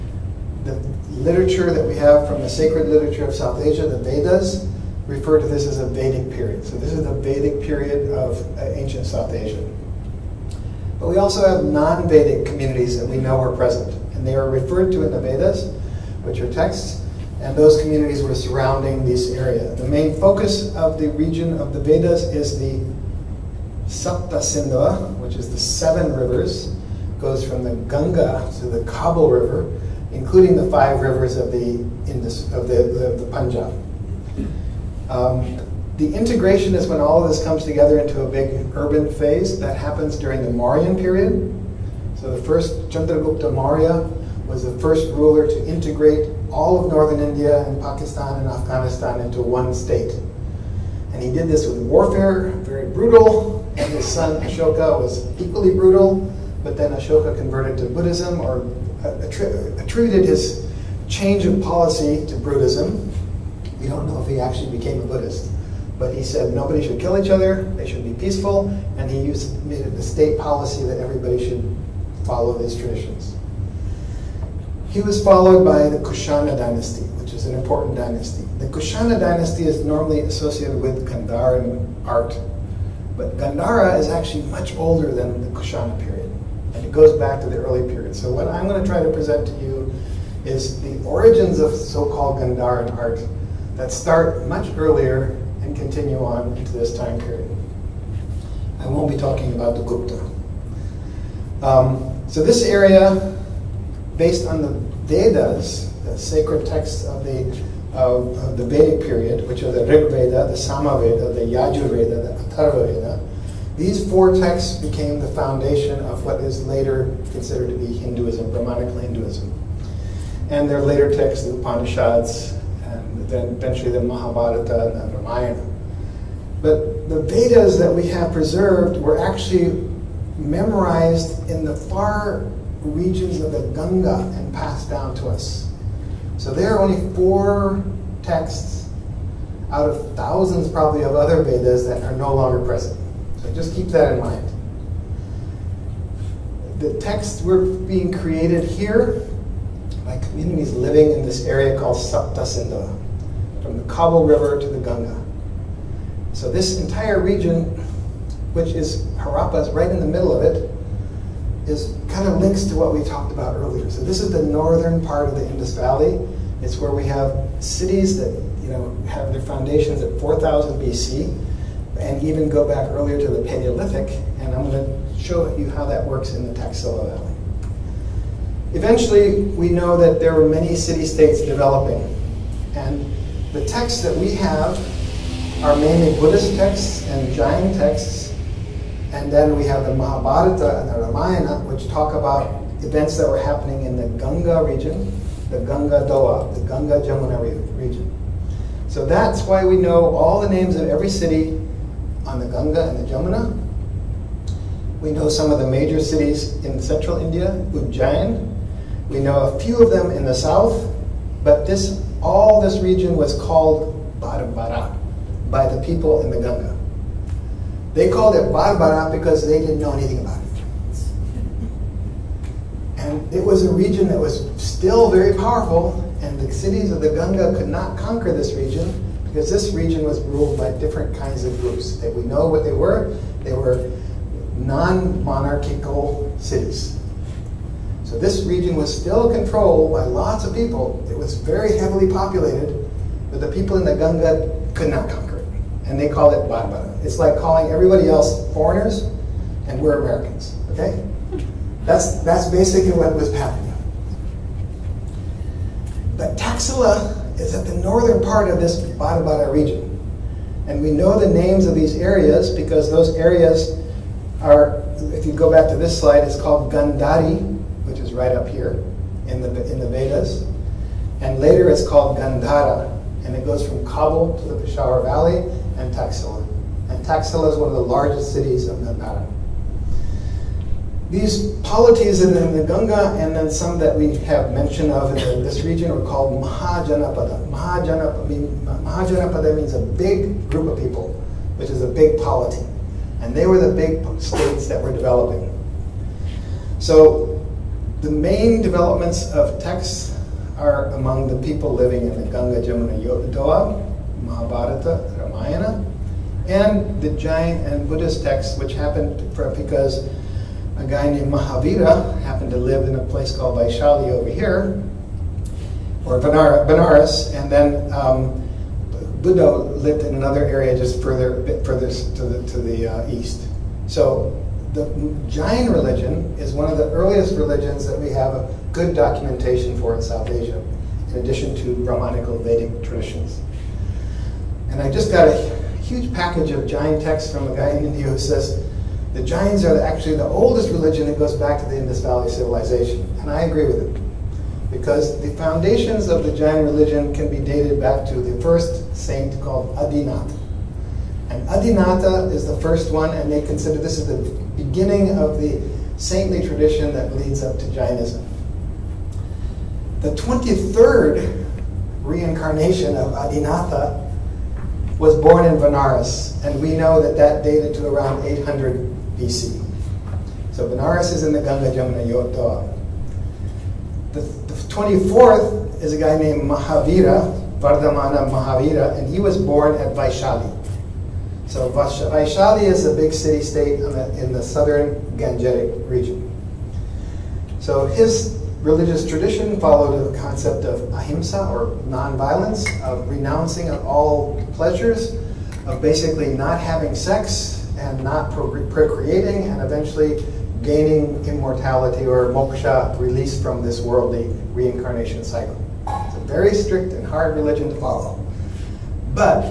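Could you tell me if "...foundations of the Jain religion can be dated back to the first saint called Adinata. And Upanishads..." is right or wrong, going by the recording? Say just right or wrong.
wrong.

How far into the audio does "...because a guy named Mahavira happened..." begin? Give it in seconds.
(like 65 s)
309 s.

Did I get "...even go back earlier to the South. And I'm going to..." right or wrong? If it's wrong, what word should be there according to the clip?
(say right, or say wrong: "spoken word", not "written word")
wrong: "Paleolithic", not "South".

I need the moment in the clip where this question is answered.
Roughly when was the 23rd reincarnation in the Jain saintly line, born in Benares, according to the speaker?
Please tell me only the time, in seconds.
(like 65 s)
368 s.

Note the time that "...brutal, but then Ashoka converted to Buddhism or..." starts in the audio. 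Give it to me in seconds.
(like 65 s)
55 s.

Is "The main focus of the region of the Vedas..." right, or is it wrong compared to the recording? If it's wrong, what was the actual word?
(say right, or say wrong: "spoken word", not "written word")
right.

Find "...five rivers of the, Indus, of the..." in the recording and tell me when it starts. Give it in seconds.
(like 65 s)
30 s.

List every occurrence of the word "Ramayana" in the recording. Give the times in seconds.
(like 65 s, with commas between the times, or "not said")
125 s, 191 s, 305 s.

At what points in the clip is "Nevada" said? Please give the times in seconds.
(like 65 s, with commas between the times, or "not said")
278 s.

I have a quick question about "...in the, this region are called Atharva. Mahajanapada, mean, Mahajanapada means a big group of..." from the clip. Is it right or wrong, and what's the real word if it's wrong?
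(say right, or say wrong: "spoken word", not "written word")
wrong: "Mahajanapada", not "Atharva".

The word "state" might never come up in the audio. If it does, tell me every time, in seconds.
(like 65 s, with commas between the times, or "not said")
49 s, 70 s, 180 s, 294 s, 383 s.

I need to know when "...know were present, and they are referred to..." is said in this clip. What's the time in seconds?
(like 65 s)
13 s.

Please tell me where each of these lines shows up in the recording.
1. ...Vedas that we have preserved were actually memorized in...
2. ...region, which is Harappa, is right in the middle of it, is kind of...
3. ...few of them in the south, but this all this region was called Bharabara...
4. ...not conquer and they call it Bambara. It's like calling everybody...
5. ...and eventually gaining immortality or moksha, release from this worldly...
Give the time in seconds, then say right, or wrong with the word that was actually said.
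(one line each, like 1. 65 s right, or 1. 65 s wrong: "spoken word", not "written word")
1. 127 s right
2. 157 s right
3. 209 s right
4. 244 s right
5. 399 s right.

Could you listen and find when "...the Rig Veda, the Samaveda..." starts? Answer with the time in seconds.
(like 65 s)
109 s.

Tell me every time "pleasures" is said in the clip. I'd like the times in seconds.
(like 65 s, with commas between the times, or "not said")
394 s.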